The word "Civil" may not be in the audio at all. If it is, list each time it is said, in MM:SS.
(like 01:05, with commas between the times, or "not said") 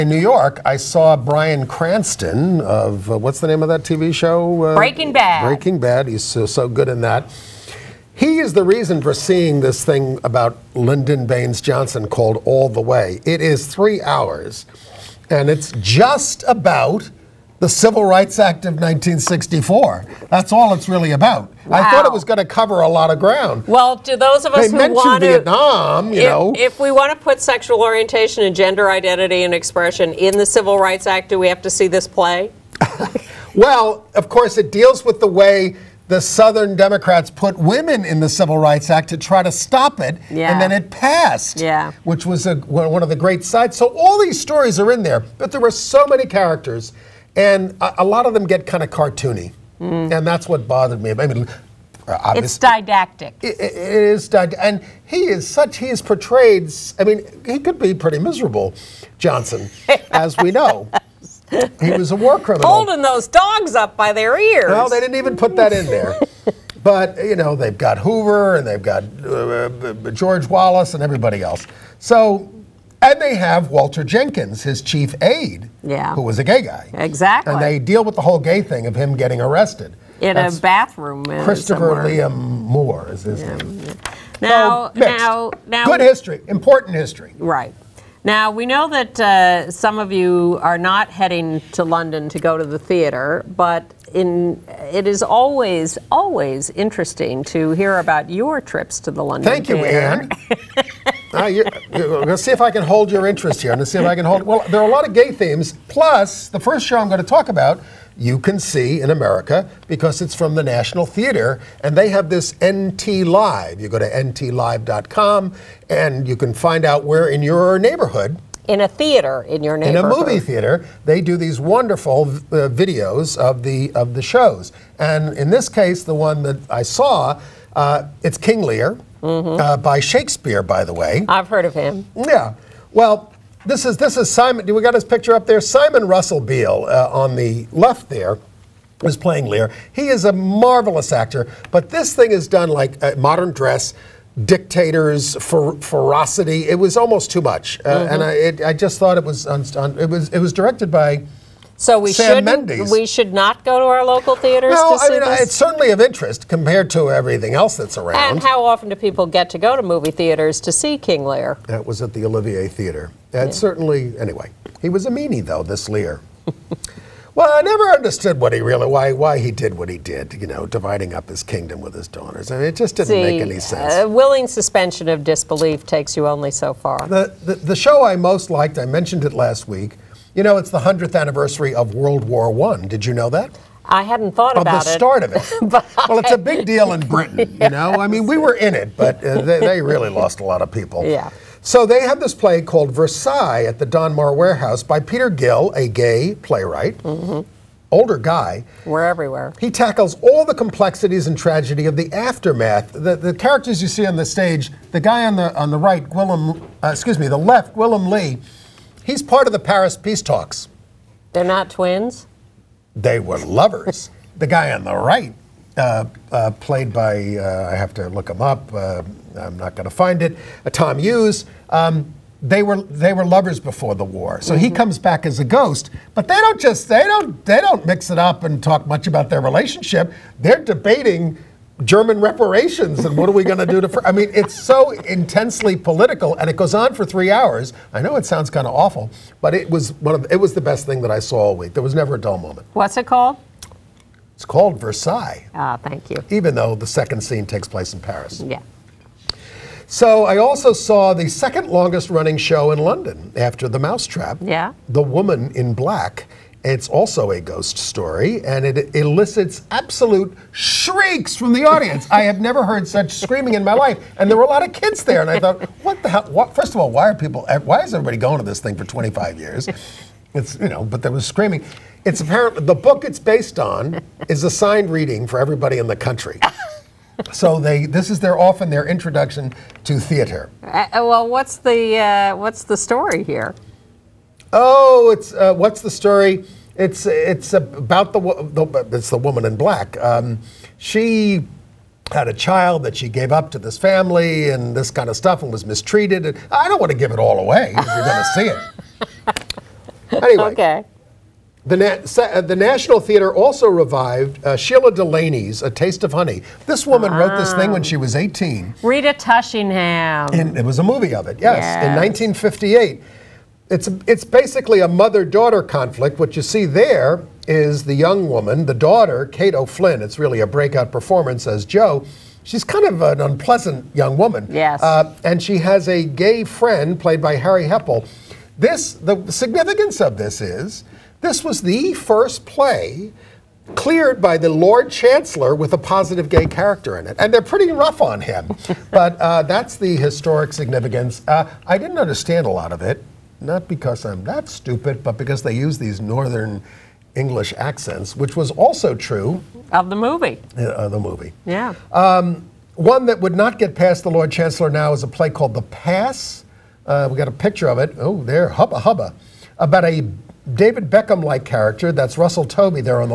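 00:17, 00:30, 00:38.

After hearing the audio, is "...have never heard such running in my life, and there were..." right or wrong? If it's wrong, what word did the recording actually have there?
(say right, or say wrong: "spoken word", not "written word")
wrong: "screaming", not "running".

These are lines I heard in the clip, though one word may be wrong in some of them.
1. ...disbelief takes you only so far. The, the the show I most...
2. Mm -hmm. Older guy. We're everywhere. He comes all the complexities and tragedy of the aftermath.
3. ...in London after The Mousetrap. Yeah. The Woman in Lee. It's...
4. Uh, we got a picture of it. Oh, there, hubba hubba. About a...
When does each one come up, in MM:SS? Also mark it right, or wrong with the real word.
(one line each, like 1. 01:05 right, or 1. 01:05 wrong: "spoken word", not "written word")
1. 02:55 right
2. 03:17 wrong: "tackles", not "comes"
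3. 04:12 wrong: "Black", not "Lee"
4. 05:56 right.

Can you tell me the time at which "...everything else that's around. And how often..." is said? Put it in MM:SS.
02:37.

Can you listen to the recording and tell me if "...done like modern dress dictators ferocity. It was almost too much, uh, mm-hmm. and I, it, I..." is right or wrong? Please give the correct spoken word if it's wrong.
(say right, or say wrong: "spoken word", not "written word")
right.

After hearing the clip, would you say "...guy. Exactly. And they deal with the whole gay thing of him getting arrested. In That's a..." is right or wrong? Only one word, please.
right.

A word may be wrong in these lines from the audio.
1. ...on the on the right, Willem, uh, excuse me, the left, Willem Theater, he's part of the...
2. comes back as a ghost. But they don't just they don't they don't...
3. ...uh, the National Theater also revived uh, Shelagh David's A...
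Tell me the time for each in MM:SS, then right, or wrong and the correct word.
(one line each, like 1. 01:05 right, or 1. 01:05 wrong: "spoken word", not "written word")
1. 03:25 wrong: "Lee", not "Theater"
2. 03:44 right
3. 05:02 wrong: "Delaney", not "David".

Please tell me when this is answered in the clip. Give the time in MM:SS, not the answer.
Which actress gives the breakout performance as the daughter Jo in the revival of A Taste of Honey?
05:19.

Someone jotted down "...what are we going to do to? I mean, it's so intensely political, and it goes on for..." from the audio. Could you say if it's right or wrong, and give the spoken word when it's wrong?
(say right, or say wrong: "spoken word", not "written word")
right.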